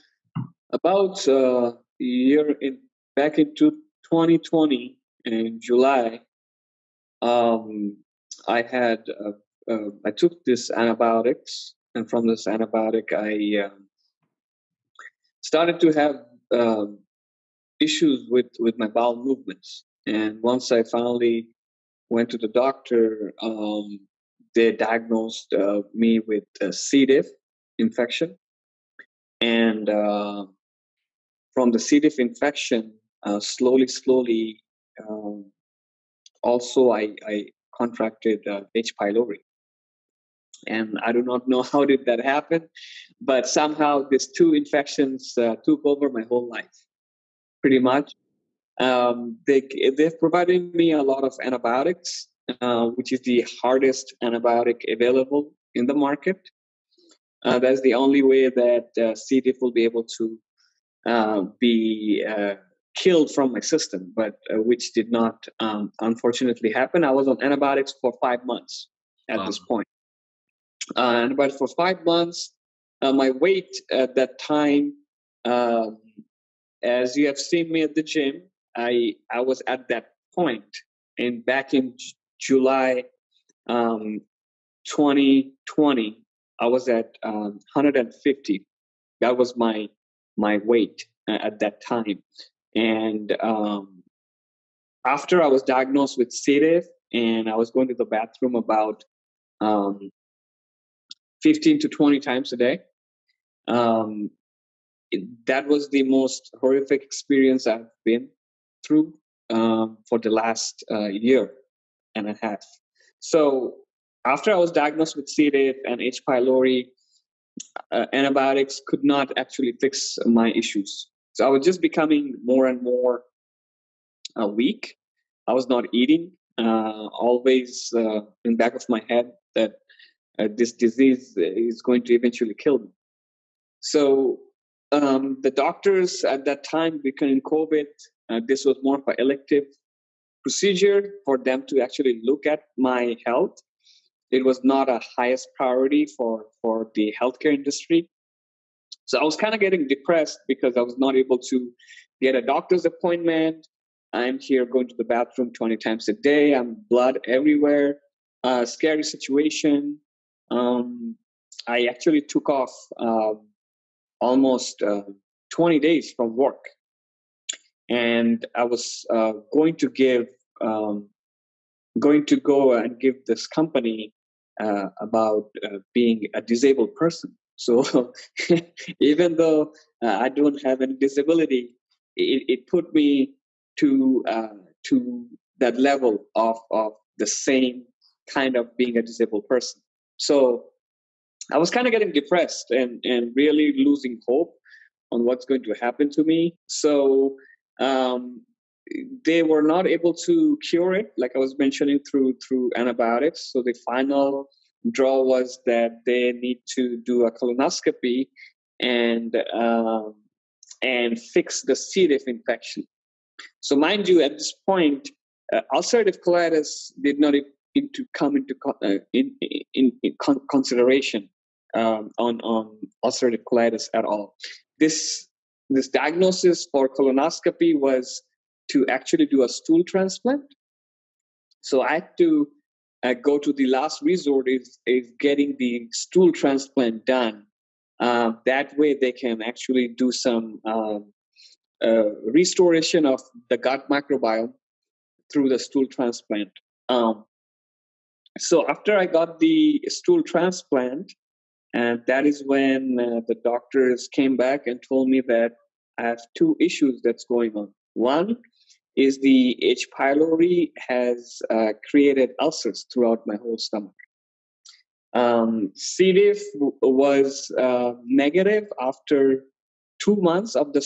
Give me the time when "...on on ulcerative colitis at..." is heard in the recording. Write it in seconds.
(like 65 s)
222 s.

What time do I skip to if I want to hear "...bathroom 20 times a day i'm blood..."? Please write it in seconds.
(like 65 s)
155 s.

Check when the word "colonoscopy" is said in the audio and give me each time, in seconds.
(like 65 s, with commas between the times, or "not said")
207 s, 226 s.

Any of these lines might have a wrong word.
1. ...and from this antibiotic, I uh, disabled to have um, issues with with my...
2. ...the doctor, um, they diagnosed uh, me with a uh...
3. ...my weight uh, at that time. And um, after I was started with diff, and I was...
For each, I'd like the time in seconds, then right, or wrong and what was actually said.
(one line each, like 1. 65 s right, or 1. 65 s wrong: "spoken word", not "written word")
1. 11 s wrong: "started", not "disabled"
2. 22 s right
3. 90 s wrong: "diagnosed", not "started".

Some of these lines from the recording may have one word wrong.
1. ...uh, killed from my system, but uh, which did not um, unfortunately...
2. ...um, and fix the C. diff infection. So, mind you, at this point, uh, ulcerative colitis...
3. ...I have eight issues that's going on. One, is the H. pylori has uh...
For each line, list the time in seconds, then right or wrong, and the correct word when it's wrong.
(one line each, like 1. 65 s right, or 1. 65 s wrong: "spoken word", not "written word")
1. 62 s right
2. 209 s right
3. 255 s wrong: "two", not "eight".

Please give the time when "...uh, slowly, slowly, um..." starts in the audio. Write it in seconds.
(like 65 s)
33 s.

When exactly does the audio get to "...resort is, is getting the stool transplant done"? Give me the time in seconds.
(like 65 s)
234 s.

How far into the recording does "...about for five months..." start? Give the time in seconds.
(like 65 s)
71 s.